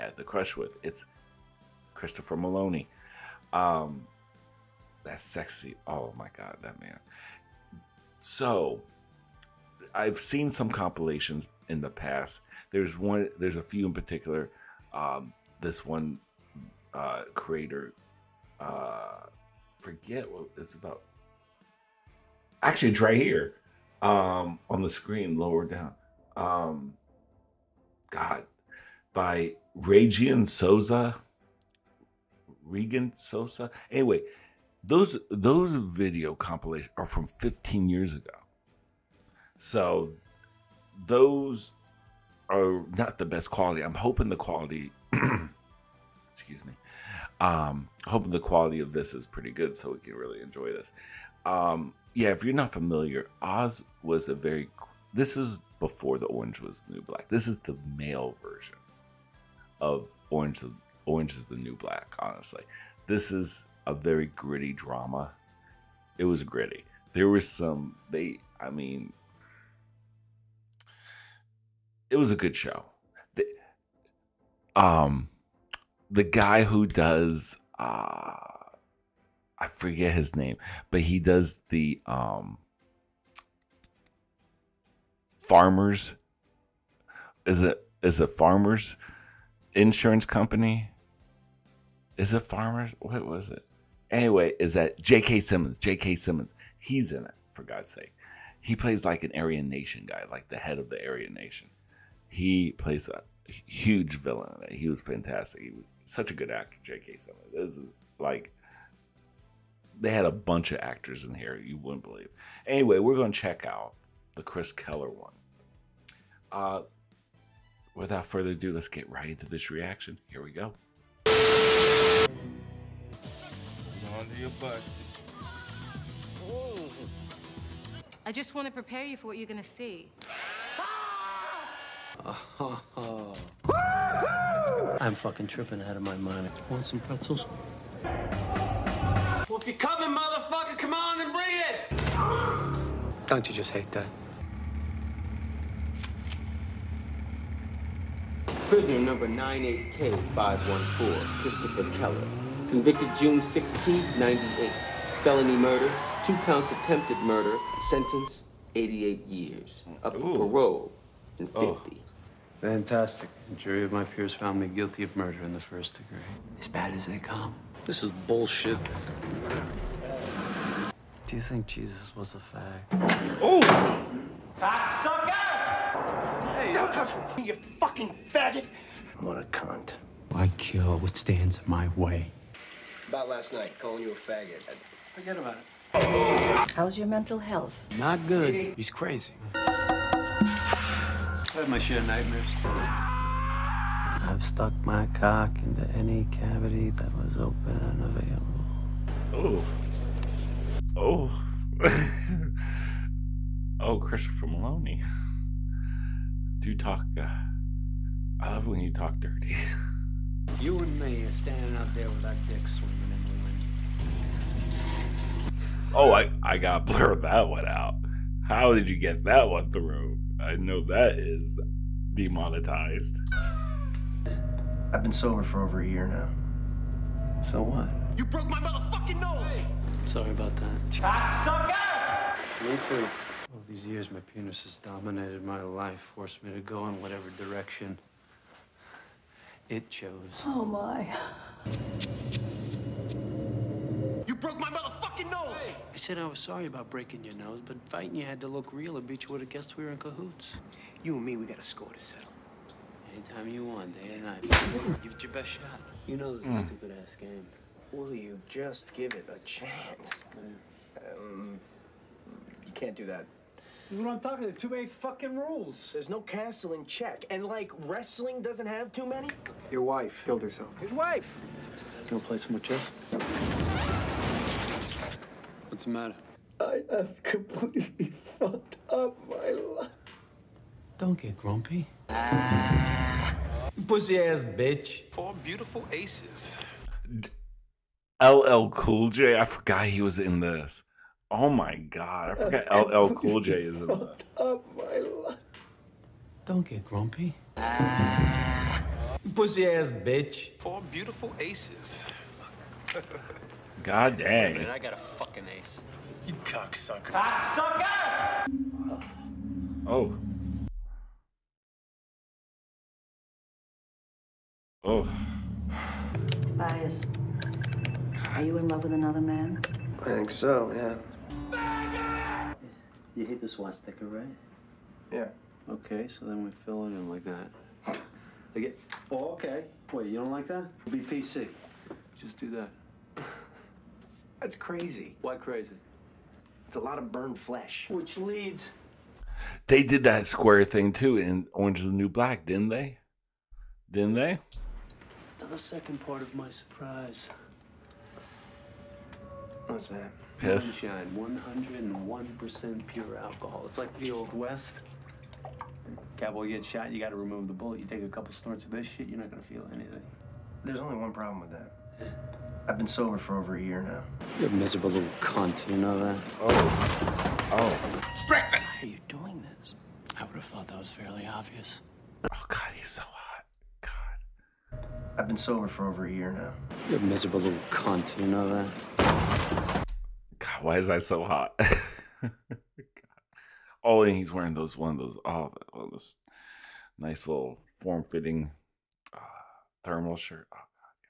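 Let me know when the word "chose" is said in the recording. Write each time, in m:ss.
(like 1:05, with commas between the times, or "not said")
3:59.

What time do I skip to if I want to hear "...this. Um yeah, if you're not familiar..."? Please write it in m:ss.
0:50.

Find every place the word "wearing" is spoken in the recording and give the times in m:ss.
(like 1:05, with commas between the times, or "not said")
6:24.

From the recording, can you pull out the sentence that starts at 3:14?
I've stuck my cock into any cavity that was open and available.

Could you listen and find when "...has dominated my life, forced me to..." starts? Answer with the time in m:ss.
3:54.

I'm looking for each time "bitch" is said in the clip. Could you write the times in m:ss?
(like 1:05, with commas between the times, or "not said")
4:08, 4:44, 4:59.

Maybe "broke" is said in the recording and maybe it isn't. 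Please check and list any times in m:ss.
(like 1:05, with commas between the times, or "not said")
3:48, 4:04.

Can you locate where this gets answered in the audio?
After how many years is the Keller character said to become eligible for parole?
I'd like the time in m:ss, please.
2:41.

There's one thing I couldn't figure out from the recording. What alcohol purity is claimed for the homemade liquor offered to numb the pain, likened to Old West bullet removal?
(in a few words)
101%.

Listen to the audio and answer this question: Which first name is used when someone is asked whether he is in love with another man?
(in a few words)
Tobias.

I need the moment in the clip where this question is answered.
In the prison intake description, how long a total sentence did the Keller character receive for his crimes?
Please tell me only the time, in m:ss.
2:38.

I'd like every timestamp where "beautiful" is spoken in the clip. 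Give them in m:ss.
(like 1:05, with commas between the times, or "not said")
4:45, 5:00.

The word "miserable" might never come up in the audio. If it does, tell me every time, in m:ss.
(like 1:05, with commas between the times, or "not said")
6:04, 6:17.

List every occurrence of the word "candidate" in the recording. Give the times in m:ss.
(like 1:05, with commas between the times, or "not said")
not said.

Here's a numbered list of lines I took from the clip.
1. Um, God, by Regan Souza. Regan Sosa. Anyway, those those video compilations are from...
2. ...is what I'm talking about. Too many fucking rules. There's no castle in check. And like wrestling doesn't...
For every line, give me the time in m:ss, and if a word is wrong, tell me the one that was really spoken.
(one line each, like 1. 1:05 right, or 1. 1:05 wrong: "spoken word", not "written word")
1. 0:26 right
2. 4:23 right.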